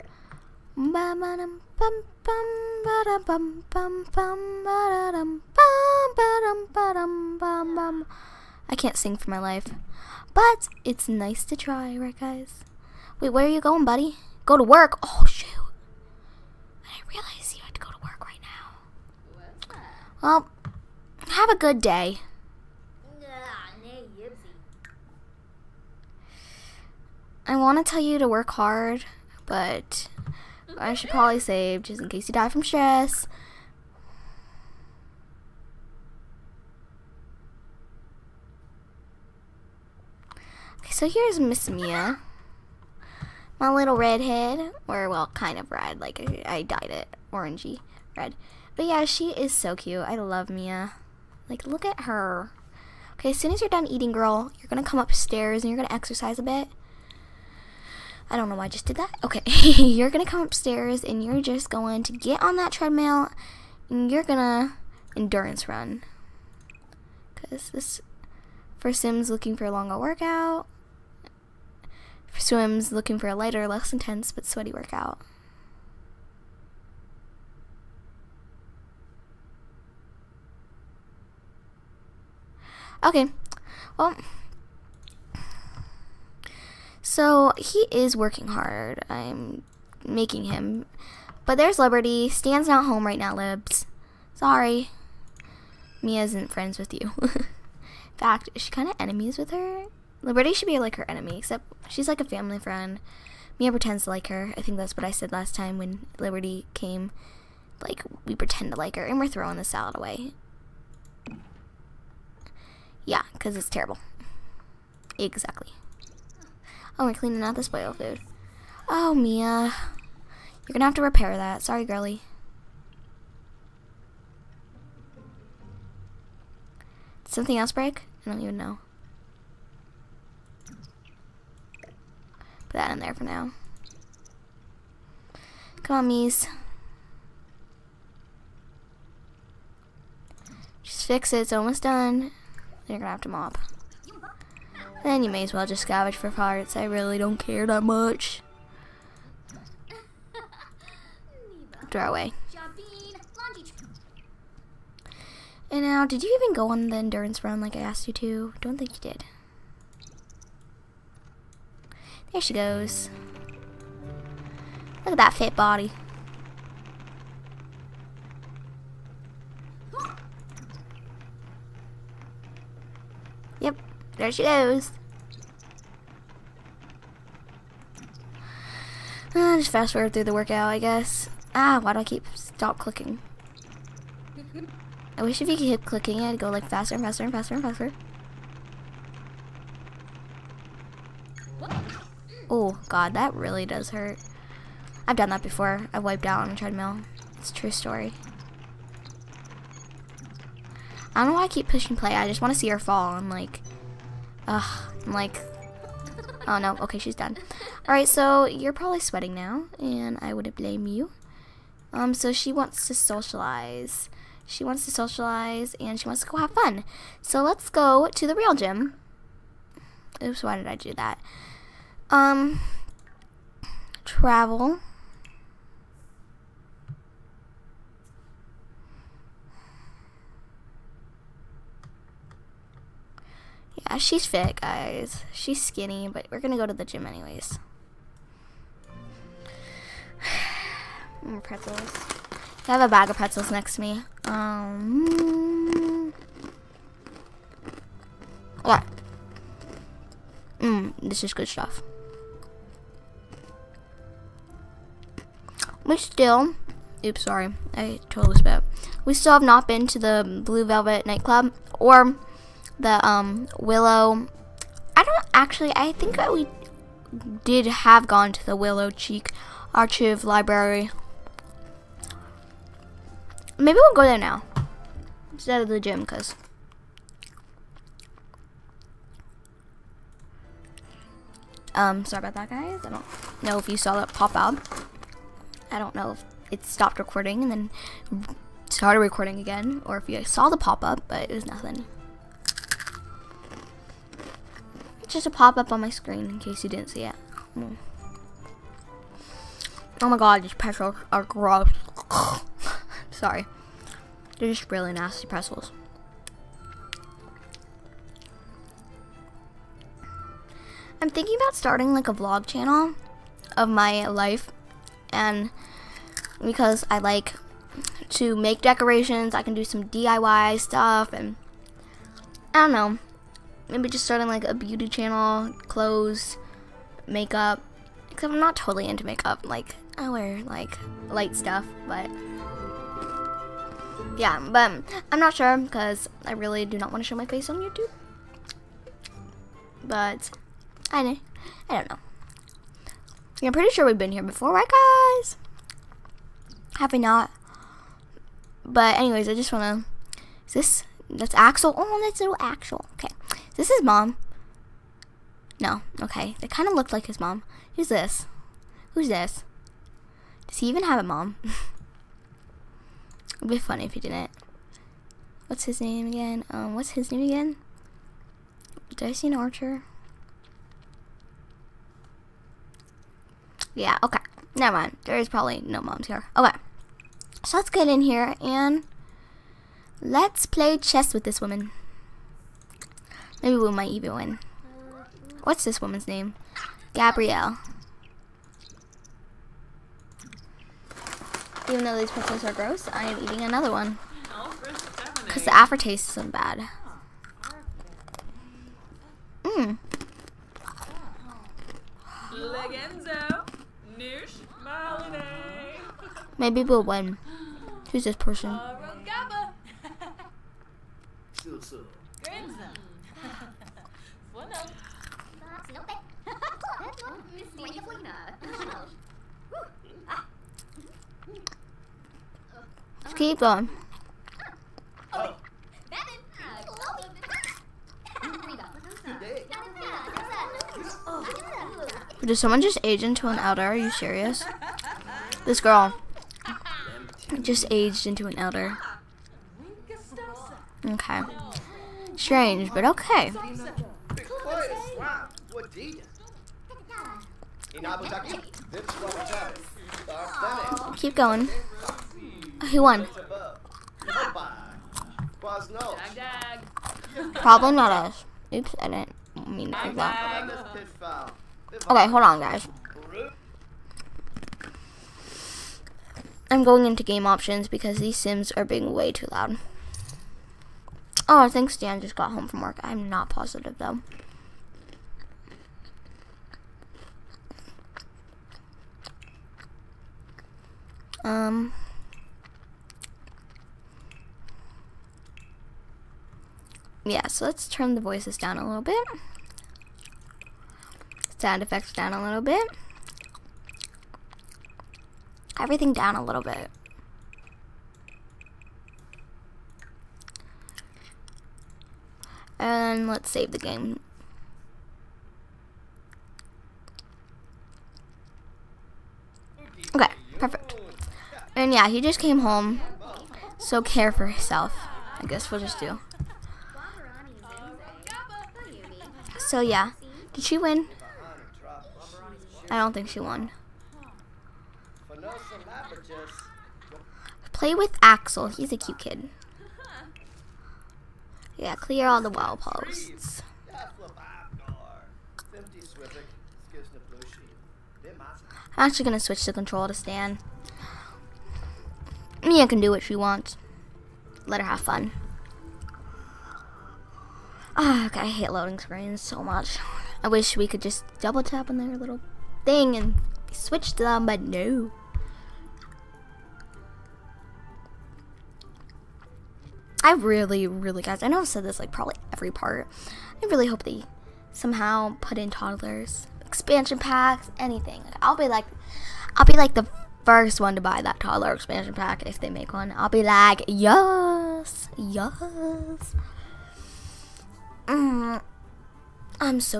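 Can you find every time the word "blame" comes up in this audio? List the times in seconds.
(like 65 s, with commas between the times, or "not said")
210 s.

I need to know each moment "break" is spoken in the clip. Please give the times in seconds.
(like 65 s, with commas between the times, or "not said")
127 s.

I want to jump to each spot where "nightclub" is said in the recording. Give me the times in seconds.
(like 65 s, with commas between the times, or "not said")
261 s.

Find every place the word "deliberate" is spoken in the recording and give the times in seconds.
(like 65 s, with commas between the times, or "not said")
not said.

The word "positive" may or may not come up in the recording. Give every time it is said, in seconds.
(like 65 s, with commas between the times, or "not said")
473 s.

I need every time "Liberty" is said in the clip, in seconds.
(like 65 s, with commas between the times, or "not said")
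91 s, 100 s, 106 s.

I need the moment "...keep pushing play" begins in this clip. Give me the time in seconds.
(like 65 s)
201 s.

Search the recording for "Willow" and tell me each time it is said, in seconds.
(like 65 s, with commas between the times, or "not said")
263 s, 268 s.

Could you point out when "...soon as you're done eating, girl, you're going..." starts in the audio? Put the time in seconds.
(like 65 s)
53 s.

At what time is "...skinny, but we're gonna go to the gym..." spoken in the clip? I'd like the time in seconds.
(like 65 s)
235 s.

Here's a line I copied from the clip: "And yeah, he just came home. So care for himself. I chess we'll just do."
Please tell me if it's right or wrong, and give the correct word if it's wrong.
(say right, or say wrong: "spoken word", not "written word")
wrong: "guess", not "chess".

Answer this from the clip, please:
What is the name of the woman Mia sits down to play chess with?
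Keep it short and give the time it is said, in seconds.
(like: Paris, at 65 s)
Gabrielle, at 386 s.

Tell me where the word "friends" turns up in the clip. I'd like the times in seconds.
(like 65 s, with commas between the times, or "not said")
96 s, 102 s.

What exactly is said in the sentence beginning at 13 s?
Wait, where are you going, buddy?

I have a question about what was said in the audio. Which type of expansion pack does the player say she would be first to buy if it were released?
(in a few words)
toddler expansion pack.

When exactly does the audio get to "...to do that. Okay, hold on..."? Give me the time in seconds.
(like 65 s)
459 s.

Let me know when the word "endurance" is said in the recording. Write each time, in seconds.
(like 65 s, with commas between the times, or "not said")
65 s, 156 s.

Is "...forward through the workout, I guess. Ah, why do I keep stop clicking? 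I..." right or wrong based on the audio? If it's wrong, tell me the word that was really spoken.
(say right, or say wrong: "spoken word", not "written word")
right.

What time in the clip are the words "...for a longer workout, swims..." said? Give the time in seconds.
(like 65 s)
69 s.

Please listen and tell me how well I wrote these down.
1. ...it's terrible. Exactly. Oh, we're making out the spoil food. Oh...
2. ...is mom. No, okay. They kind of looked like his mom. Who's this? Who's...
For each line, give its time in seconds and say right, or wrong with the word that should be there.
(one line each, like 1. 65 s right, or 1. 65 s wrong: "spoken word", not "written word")
1. 113 s wrong: "cleaning", not "making"
2. 353 s right.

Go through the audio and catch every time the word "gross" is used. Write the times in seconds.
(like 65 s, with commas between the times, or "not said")
301 s, 392 s.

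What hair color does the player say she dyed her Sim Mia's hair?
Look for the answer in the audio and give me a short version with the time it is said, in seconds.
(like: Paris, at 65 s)
orangey red, at 47 s.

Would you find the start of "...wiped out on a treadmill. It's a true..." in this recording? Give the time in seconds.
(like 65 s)
196 s.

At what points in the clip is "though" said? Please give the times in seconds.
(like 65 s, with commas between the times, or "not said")
391 s, 473 s.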